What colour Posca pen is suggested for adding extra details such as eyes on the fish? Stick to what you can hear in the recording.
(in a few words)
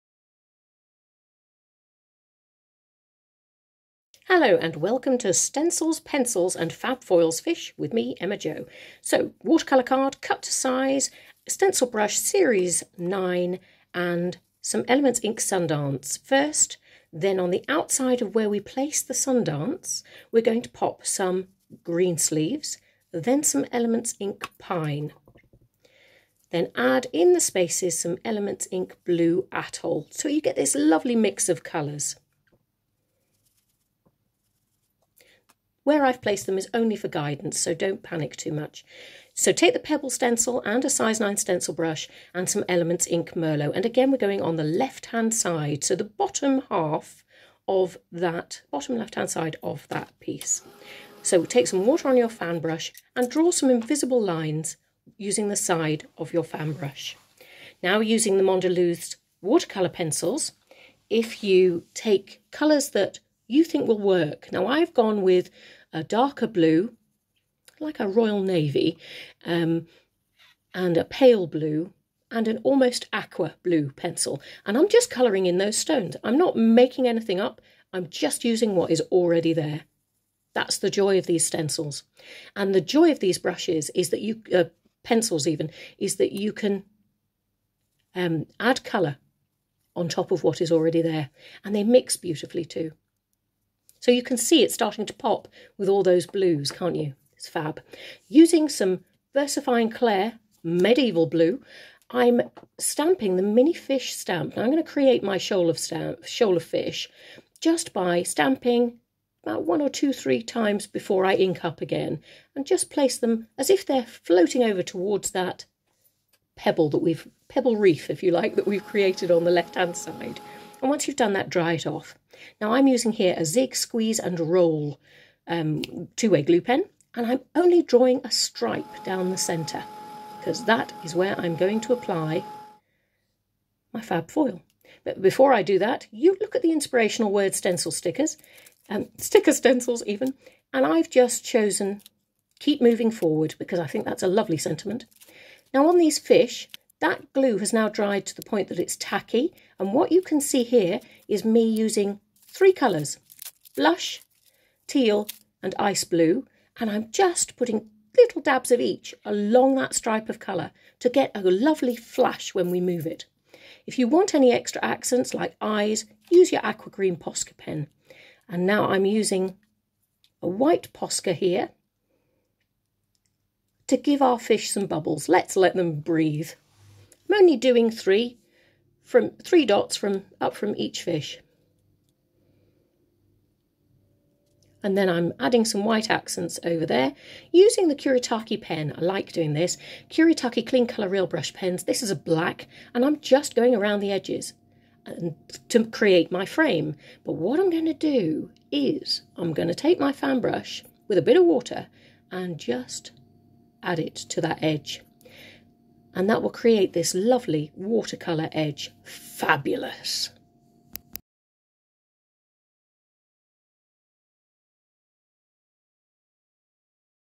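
aqua green.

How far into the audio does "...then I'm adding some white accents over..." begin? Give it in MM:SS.
03:04.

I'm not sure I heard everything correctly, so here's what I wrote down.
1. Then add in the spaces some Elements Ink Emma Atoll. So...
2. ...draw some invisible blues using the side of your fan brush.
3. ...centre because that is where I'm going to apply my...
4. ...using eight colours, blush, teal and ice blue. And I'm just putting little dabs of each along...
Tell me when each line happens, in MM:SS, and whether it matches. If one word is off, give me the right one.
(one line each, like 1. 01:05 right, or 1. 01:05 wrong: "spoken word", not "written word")
1. 00:26 wrong: "Blue", not "Emma"
2. 00:53 wrong: "lines", not "blues"
3. 02:09 right
4. 02:31 wrong: "three", not "eight".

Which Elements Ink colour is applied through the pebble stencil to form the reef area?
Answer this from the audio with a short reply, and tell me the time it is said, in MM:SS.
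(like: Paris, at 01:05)
Merlot, at 00:42.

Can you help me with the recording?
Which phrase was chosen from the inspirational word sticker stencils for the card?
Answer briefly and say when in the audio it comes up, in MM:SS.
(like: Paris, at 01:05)
keep moving forward, at 02:22.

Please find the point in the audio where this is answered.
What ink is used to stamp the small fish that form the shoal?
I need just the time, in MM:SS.
01:39.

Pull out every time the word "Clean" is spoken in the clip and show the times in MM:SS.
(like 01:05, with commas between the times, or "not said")
03:10.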